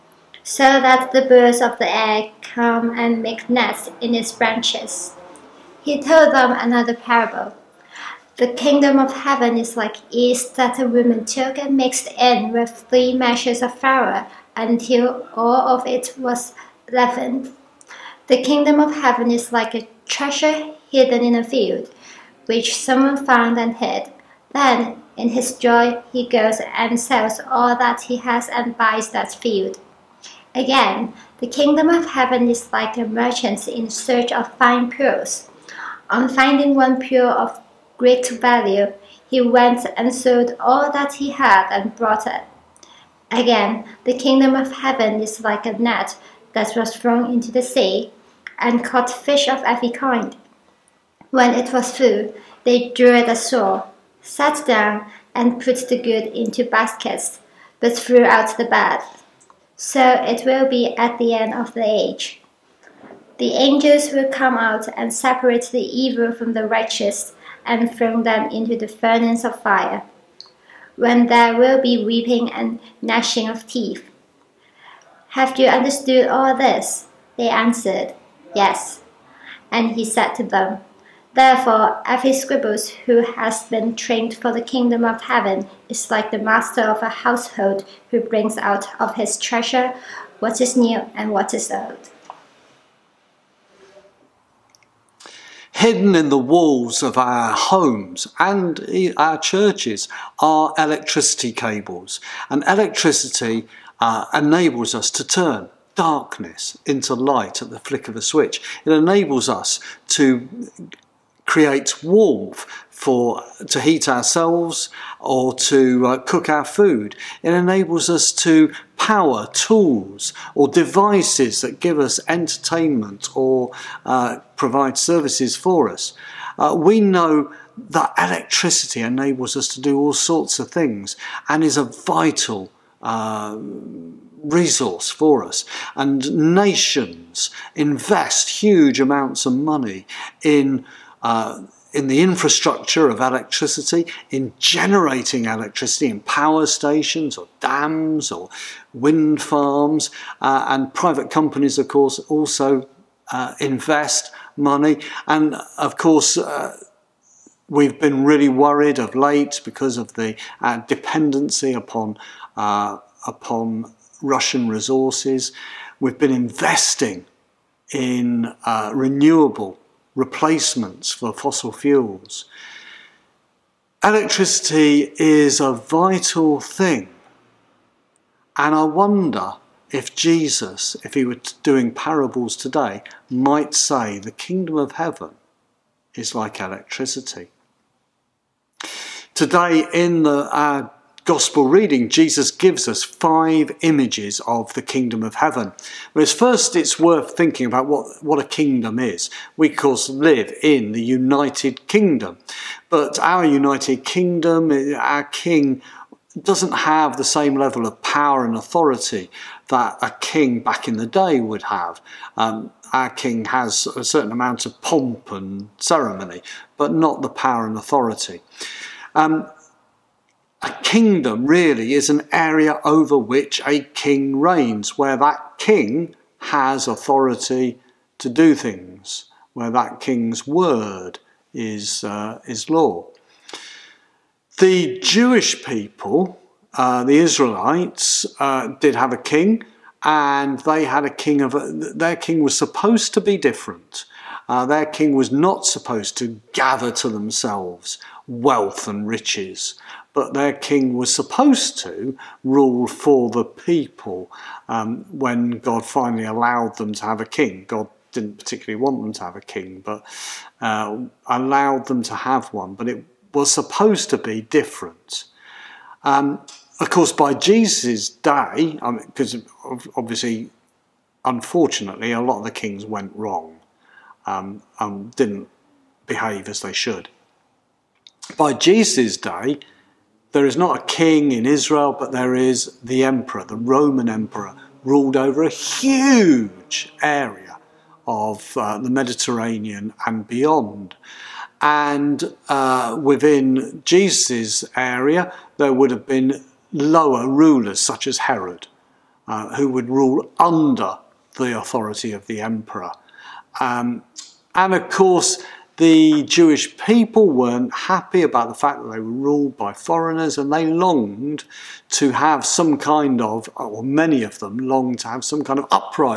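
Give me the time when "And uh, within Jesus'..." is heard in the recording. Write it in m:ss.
4:51.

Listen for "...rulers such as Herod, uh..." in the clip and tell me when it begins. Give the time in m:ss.
4:57.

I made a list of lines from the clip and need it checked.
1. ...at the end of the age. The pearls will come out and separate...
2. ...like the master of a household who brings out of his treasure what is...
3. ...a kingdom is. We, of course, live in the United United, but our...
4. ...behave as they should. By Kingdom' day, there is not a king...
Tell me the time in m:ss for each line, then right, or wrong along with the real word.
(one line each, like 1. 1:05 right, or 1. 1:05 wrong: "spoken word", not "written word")
1. 1:00 wrong: "angels", not "pearls"
2. 1:26 right
3. 3:18 wrong: "Kingdom", not "United"
4. 4:36 wrong: "Jesus", not "Kingdom".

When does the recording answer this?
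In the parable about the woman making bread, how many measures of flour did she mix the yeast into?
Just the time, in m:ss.
0:12.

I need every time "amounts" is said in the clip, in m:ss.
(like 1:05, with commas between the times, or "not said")
2:19, 3:34.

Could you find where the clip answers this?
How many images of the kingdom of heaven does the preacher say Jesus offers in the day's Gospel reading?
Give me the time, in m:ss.
3:13.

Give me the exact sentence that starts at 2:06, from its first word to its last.
Uh, we know that electricity enables us to do all sorts of things and is a vital um, resource for us.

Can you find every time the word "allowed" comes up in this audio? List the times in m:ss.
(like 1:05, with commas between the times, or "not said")
4:16, 4:21.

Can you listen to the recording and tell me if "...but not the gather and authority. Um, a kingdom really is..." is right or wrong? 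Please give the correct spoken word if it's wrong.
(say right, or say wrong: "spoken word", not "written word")
wrong: "power", not "gather".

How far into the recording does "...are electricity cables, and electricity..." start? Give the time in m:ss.
1:40.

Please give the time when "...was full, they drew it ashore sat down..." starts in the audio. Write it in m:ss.
0:51.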